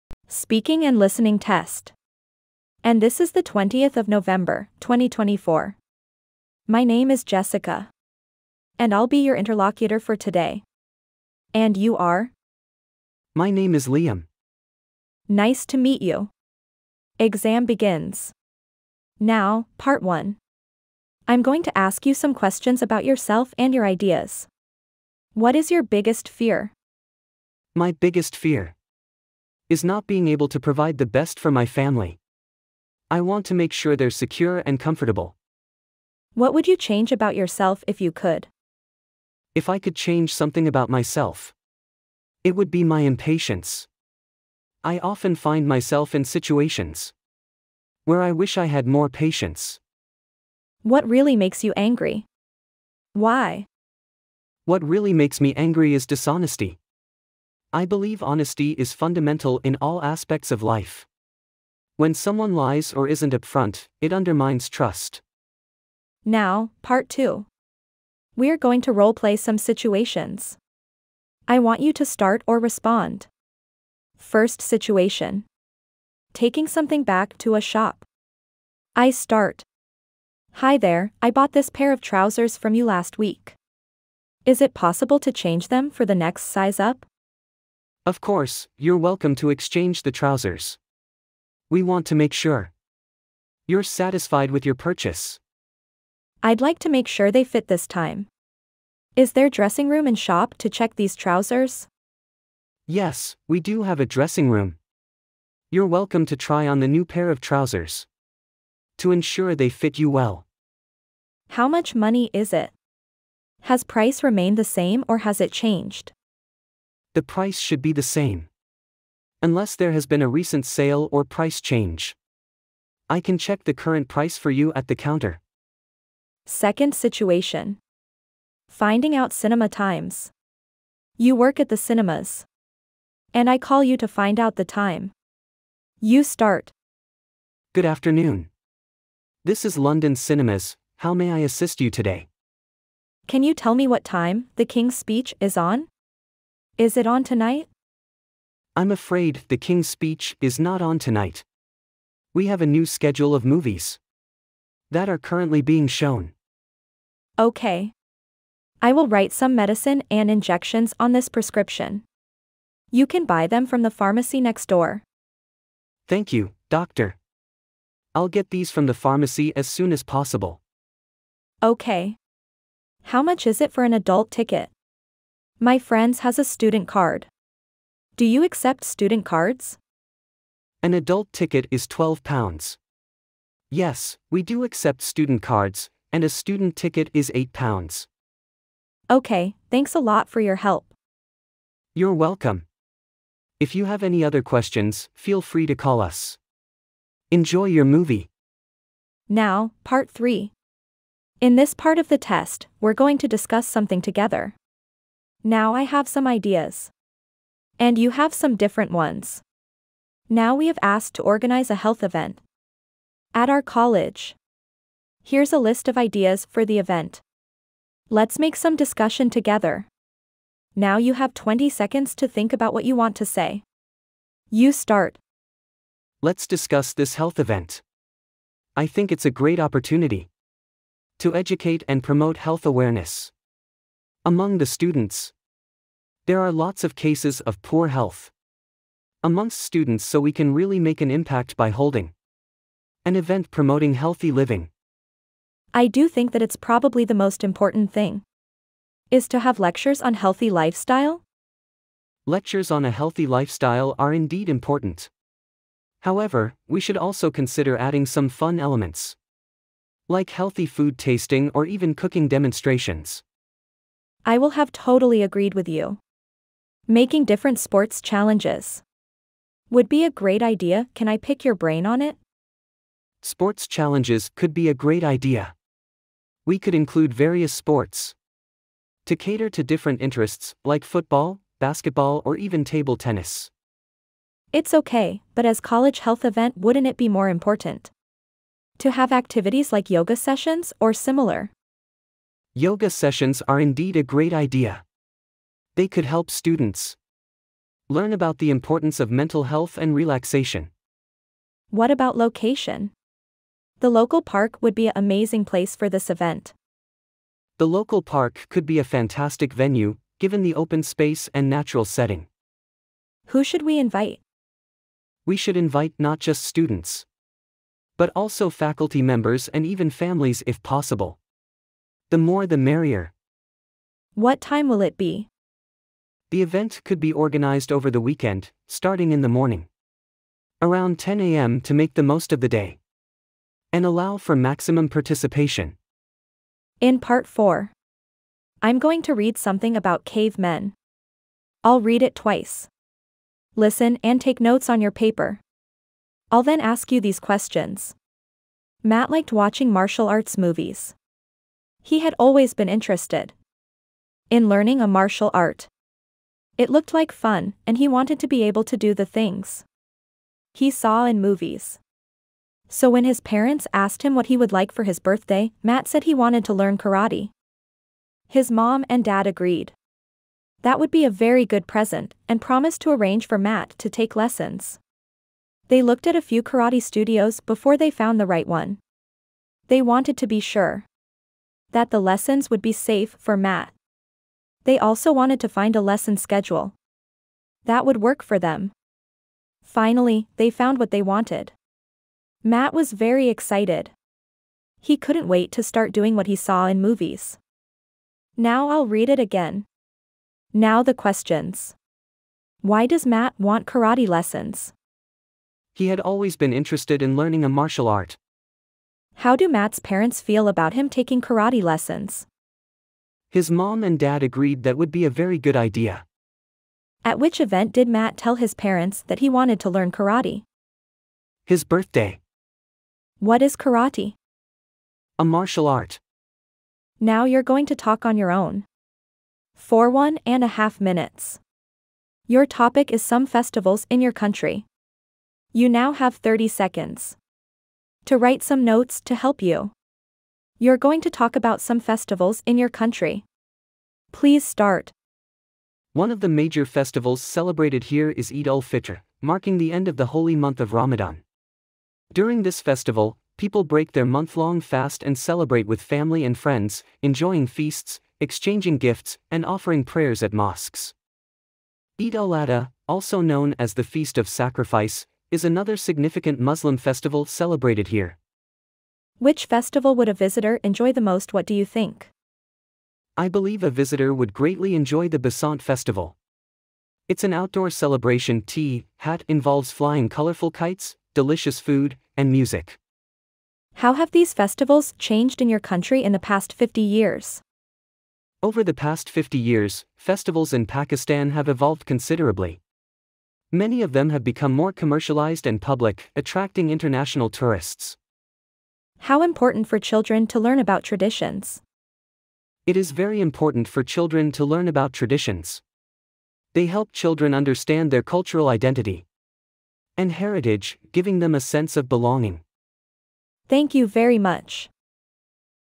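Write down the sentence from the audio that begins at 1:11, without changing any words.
I want you to start or respond.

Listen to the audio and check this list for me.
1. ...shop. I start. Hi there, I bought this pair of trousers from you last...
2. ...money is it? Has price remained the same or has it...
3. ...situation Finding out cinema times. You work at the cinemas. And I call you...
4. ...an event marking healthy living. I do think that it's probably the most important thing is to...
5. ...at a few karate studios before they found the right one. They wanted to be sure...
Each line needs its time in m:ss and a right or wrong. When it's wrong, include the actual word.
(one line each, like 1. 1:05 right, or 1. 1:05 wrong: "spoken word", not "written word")
1. 1:17 right
2. 1:51 right
3. 2:06 right
4. 4:03 wrong: "promoting", not "marking"
5. 6:16 right.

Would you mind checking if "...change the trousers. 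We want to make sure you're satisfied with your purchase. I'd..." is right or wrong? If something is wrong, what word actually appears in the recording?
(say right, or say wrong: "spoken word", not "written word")
wrong: "exchange", not "change".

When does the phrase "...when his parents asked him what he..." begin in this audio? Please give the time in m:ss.
6:02.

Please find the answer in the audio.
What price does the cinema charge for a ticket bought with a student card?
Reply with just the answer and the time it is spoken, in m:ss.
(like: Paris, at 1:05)
£8, at 3:07.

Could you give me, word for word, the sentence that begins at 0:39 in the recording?
If I could change something about myself, it would be my impatience.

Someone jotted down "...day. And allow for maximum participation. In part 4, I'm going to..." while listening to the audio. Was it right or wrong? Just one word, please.
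right.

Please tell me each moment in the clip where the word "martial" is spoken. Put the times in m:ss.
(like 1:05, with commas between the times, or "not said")
5:49, 5:54, 6:47, 7:05.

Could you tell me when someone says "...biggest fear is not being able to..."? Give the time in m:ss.
0:27.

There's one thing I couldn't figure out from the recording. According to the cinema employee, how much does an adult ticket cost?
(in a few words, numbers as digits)
£12.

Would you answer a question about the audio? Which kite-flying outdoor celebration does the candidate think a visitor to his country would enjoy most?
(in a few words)
Basant Festival.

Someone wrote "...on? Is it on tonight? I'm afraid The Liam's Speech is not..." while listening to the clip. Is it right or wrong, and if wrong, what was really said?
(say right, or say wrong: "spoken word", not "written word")
wrong: "King", not "Liam".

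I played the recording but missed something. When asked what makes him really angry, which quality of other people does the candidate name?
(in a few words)
dishonesty.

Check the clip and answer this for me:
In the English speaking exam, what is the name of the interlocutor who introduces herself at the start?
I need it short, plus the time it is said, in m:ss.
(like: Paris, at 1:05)
Jessica, at 0:07.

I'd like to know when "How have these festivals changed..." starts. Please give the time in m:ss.
8:03.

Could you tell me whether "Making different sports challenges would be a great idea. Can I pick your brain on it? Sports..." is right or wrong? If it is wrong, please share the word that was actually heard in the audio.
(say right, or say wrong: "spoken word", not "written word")
right.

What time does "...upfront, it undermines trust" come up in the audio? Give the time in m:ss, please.
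1:03.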